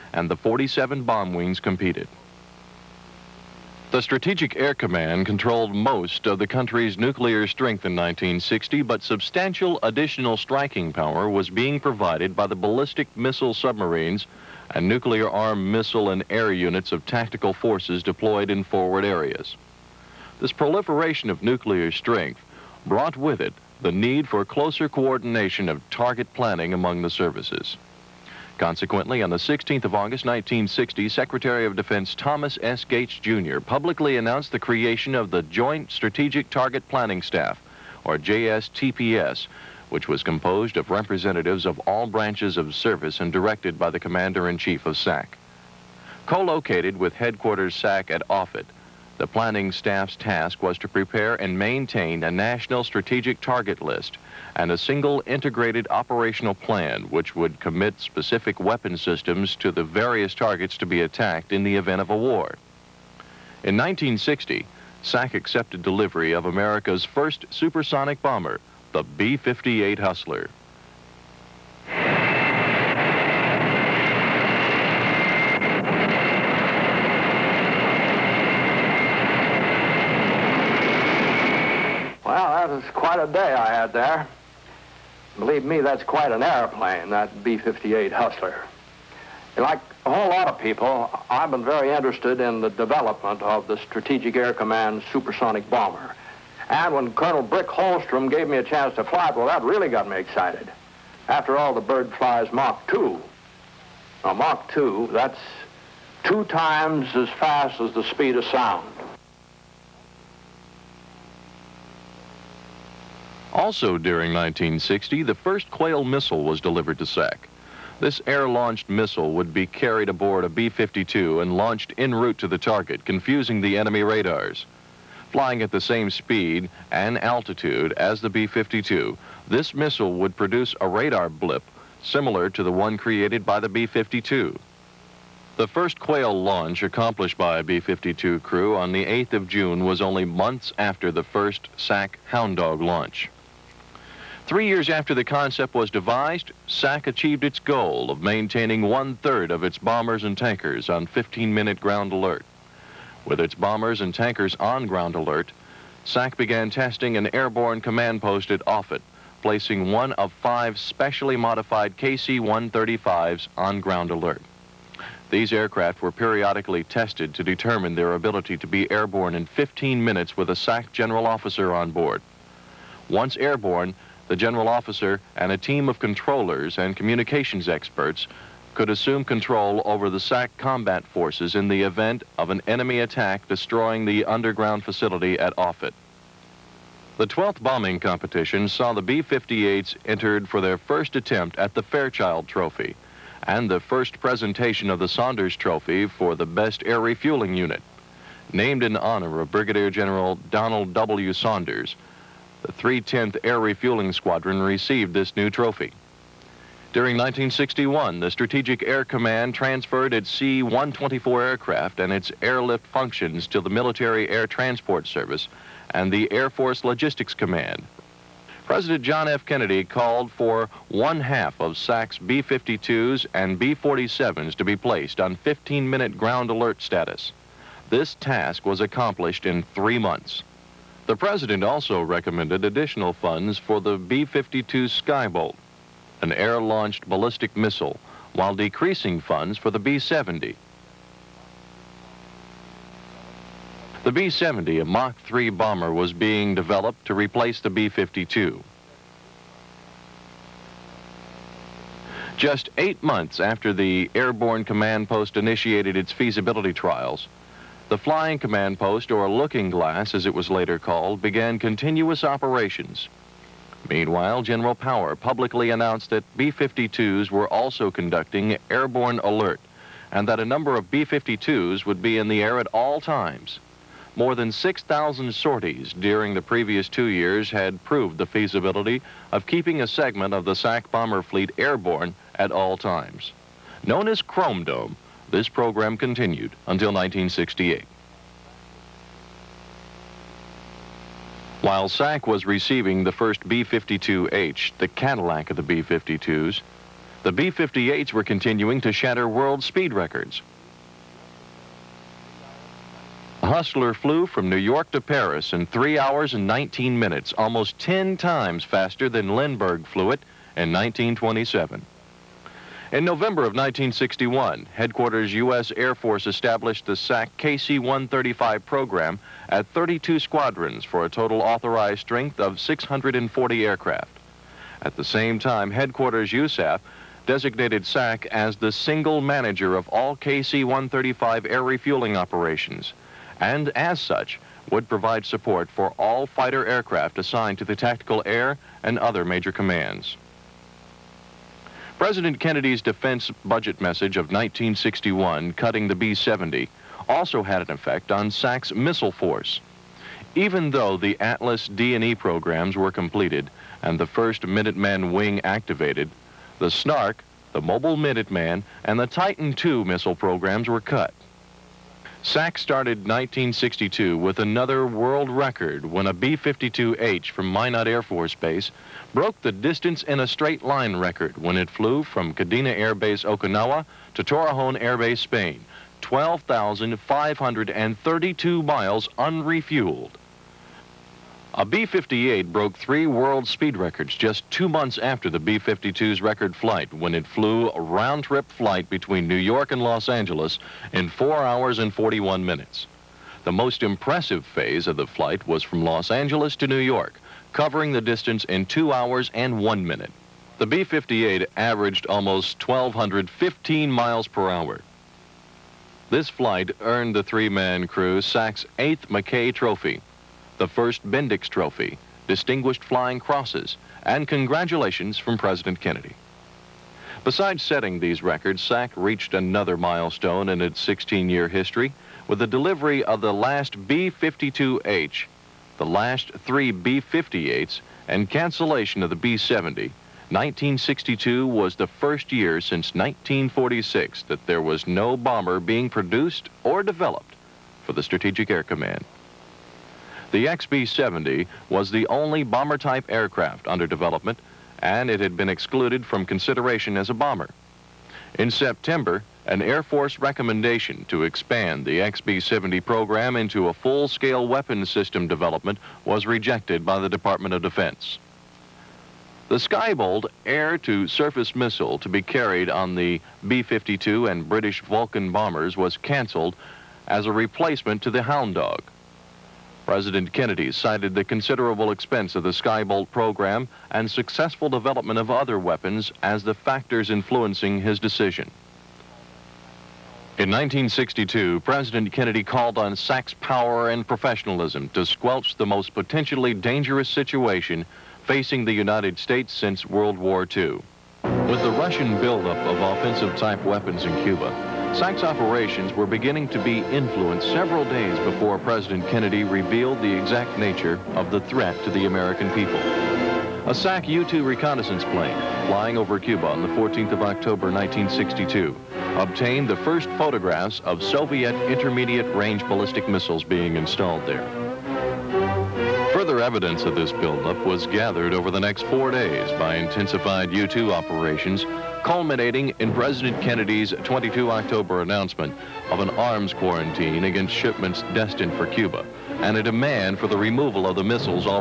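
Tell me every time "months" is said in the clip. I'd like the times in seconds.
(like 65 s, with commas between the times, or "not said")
140 s, 229 s, 253 s, 384 s.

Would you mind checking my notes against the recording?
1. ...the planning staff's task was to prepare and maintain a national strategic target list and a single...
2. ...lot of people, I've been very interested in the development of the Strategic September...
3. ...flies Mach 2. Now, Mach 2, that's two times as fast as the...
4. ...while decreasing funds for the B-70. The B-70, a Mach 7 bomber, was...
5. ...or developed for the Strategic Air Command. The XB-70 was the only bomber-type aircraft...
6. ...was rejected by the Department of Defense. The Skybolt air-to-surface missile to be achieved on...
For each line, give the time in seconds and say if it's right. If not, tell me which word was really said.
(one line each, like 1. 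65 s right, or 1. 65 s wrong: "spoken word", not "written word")
1. 49 s right
2. 90 s wrong: "Air", not "September"
3. 102 s right
4. 238 s wrong: "3", not "7"
5. 436 s right
6. 456 s wrong: "carried", not "achieved".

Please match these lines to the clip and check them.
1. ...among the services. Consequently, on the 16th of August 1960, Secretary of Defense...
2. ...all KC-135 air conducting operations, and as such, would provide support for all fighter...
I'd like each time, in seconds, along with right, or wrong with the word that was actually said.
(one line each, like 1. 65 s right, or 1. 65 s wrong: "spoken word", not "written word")
1. 26 s right
2. 329 s wrong: "refueling", not "conducting".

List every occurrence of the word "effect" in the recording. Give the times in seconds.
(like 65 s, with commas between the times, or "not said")
347 s.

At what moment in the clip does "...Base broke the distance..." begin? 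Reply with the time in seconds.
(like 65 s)
368 s.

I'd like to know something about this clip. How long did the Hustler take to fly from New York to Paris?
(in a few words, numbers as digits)
3 hours and 19 minutes.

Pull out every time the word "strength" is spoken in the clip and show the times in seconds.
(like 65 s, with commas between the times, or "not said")
7 s, 21 s, 321 s.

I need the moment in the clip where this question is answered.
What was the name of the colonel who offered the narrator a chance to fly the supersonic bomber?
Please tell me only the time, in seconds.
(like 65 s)
97 s.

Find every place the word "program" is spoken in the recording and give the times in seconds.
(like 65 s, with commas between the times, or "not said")
285 s, 318 s, 352 s, 360 s, 452 s, 473 s.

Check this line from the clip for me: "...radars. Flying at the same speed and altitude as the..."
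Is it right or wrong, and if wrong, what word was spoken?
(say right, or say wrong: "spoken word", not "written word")
right.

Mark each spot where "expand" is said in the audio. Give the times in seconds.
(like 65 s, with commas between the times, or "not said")
451 s.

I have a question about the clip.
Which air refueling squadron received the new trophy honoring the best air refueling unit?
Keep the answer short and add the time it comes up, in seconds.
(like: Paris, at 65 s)
310th Air Refueling Squadron, at 202 s.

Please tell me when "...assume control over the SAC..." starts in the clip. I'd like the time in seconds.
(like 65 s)
178 s.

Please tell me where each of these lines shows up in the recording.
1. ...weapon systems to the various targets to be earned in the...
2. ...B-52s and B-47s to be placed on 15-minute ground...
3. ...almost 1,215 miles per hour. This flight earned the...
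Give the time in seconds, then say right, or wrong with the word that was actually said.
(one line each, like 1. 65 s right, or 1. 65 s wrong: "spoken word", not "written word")
1. 58 s wrong: "attacked", not "earned"
2. 222 s right
3. 402 s right.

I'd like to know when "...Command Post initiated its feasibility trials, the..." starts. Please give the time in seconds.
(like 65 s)
254 s.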